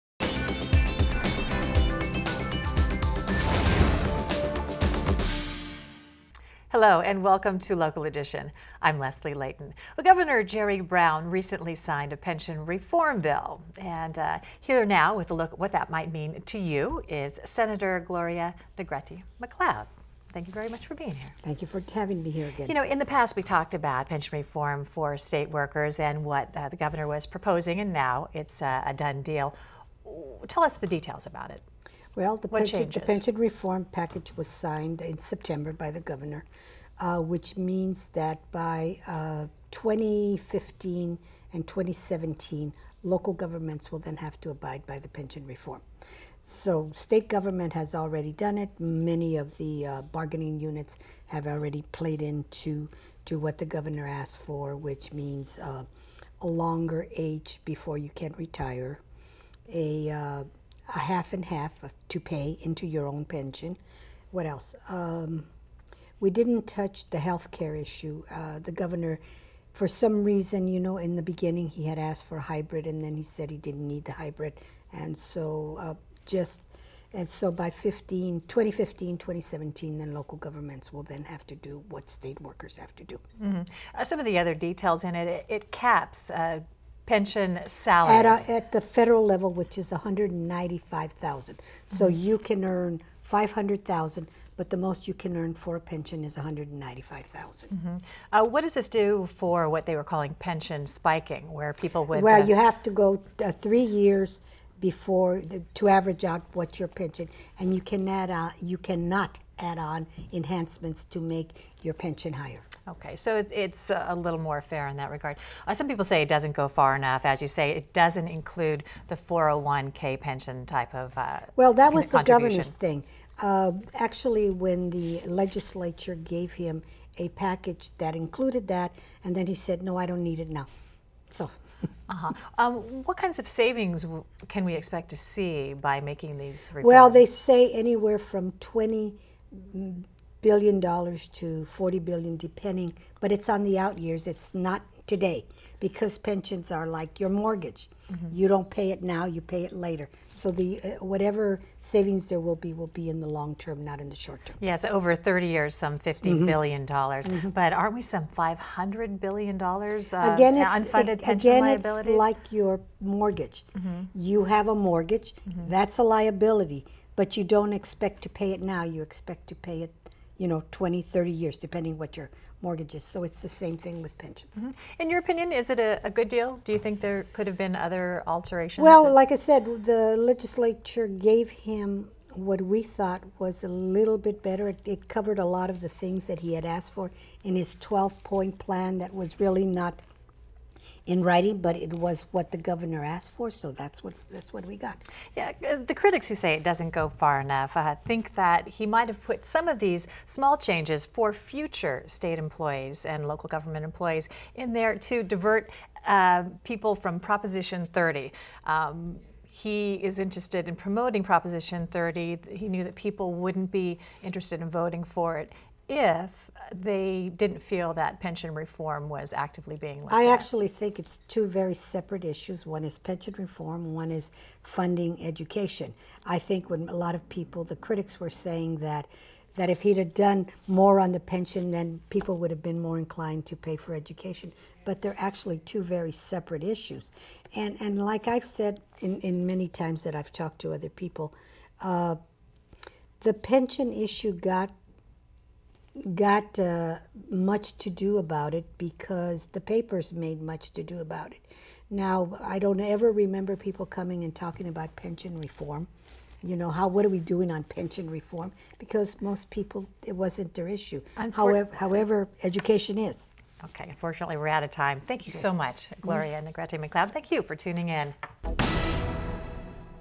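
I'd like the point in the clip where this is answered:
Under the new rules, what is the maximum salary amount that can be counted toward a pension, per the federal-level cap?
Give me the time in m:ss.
1:29.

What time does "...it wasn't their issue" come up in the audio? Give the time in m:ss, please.
4:20.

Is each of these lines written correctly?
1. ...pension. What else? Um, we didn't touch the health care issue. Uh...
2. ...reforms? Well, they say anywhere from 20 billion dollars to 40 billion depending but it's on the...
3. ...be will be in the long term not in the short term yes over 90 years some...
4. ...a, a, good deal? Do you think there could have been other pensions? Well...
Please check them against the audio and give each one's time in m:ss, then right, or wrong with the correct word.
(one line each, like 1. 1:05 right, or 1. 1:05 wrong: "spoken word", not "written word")
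1. 1:03 right
2. 2:16 right
3. 2:32 wrong: "30", not "90"
4. 2:55 wrong: "alterations", not "pensions".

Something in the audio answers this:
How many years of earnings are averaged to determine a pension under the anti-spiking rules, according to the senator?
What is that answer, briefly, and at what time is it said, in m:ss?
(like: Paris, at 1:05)
3, at 1:43.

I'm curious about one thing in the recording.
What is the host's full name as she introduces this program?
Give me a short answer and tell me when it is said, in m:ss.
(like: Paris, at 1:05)
Leslie Leyton, at 0:08.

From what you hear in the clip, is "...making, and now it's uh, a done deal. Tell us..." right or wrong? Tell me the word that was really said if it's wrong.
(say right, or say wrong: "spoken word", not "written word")
wrong: "proposing", not "making".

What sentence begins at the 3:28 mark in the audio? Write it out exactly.
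Um, he is interested in promoting Proposition 30.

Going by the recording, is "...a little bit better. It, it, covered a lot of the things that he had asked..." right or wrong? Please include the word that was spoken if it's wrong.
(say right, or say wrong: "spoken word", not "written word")
right.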